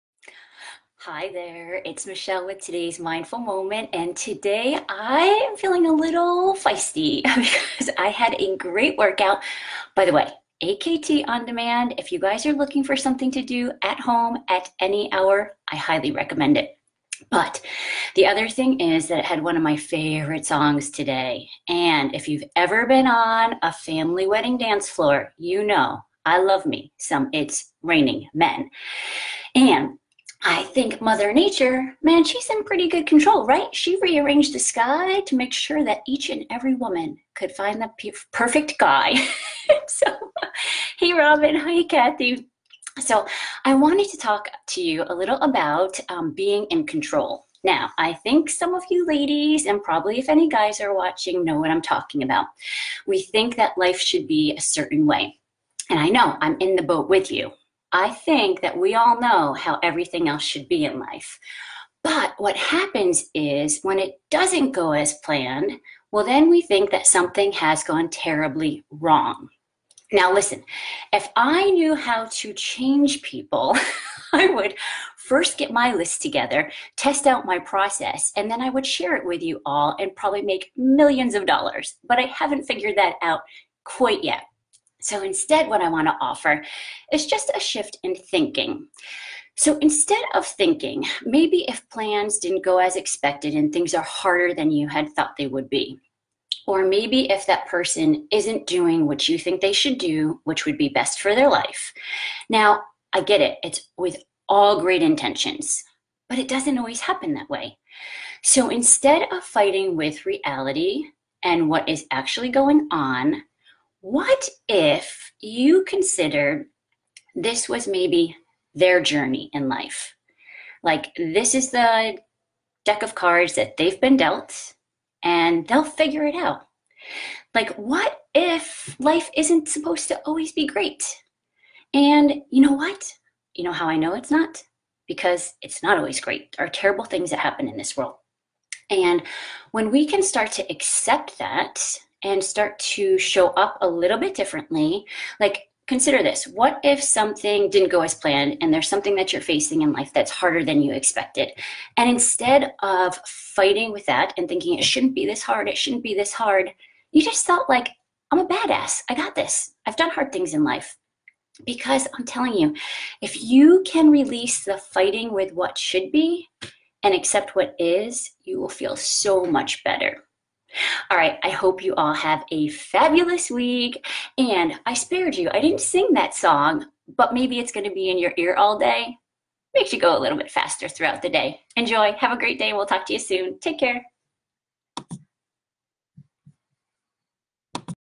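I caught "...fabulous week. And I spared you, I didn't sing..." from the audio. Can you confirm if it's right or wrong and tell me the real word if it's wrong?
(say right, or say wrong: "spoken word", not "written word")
right.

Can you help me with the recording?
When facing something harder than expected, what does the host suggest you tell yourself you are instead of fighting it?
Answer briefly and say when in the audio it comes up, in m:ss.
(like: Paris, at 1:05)
a badass, at 2:38.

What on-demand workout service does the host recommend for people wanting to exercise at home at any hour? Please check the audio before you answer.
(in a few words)
AKT.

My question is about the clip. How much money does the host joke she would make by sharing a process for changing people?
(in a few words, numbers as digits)
millions of dollars.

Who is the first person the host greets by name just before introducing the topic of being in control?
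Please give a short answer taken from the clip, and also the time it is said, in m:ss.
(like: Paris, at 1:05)
Robin, at 0:41.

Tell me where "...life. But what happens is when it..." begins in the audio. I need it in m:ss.
1:00.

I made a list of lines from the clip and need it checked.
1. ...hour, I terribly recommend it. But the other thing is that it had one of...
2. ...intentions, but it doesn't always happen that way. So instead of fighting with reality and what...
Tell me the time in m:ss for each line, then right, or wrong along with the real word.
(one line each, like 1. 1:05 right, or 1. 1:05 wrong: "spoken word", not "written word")
1. 0:15 wrong: "highly", not "terribly"
2. 1:45 right.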